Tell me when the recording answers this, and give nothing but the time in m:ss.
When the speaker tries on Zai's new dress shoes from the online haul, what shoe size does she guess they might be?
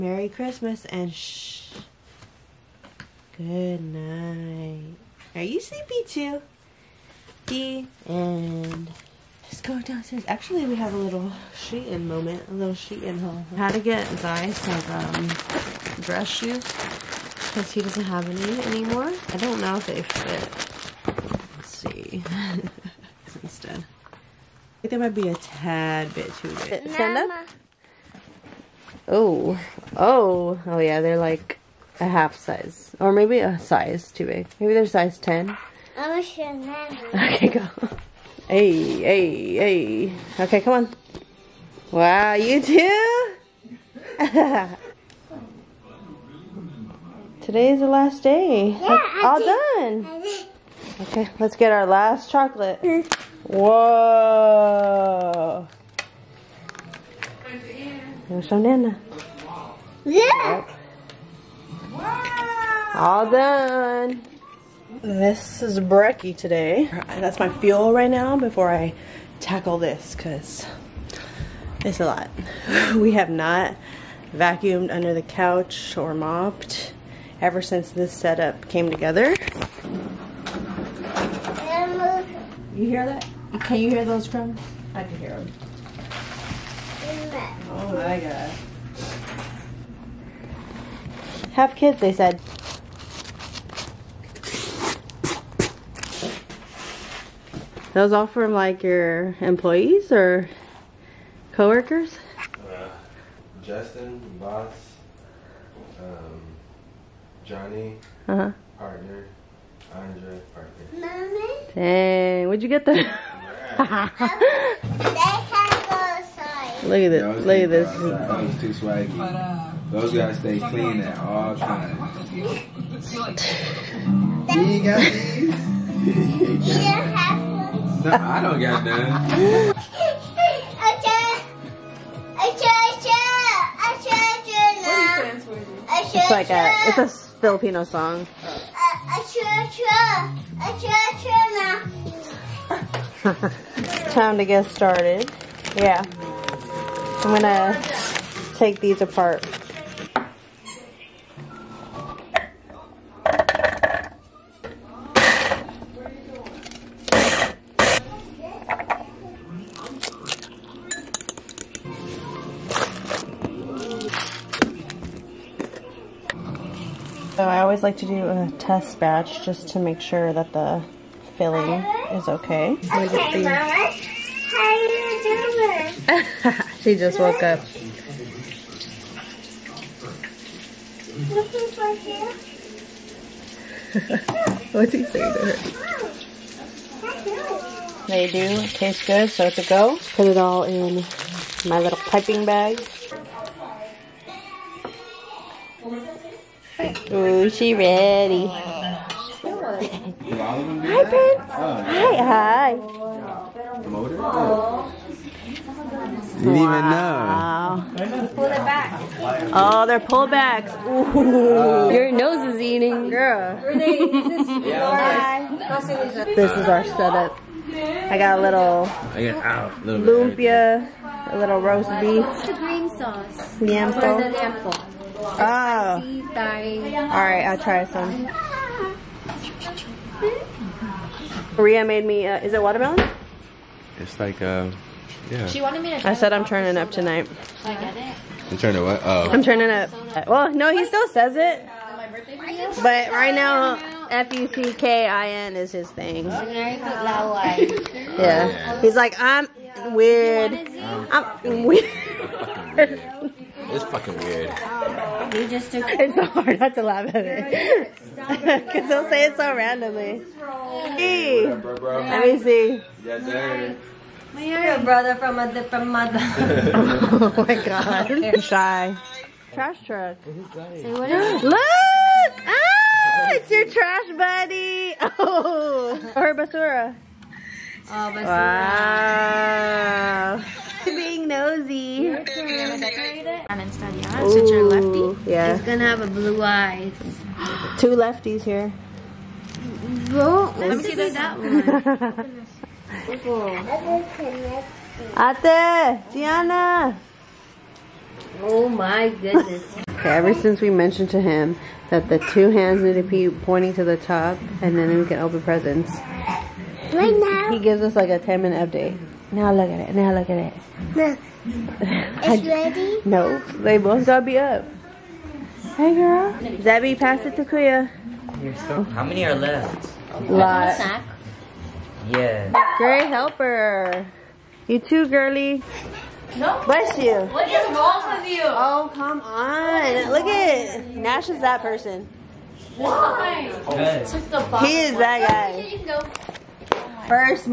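0:34.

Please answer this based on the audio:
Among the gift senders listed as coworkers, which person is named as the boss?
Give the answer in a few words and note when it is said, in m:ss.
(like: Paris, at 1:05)
Justin, at 1:43.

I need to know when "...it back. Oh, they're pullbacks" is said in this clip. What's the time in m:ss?
3:28.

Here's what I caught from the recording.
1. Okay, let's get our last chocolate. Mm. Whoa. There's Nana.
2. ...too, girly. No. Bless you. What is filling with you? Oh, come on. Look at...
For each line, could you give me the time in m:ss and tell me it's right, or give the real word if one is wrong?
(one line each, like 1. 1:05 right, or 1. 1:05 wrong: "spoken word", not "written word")
1. 0:51 right
2. 5:24 wrong: "wrong", not "filling".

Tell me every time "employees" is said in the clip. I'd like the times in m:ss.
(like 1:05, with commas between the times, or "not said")
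1:39.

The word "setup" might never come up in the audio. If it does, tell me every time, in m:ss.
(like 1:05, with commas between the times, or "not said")
1:18, 3:36.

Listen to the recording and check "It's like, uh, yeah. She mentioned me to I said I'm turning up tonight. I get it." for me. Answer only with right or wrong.
wrong.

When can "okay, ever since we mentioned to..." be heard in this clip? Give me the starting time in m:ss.
4:59.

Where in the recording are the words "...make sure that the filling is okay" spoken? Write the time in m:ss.
2:49.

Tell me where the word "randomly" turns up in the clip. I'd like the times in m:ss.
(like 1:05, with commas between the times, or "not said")
4:19.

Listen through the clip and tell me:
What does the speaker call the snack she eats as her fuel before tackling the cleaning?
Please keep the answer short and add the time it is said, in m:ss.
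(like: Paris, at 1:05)
brekkie, at 1:05.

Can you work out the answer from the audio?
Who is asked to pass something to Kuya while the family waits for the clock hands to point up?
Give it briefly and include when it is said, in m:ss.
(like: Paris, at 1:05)
Zabby, at 5:16.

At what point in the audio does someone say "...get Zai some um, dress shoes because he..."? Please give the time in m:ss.
0:13.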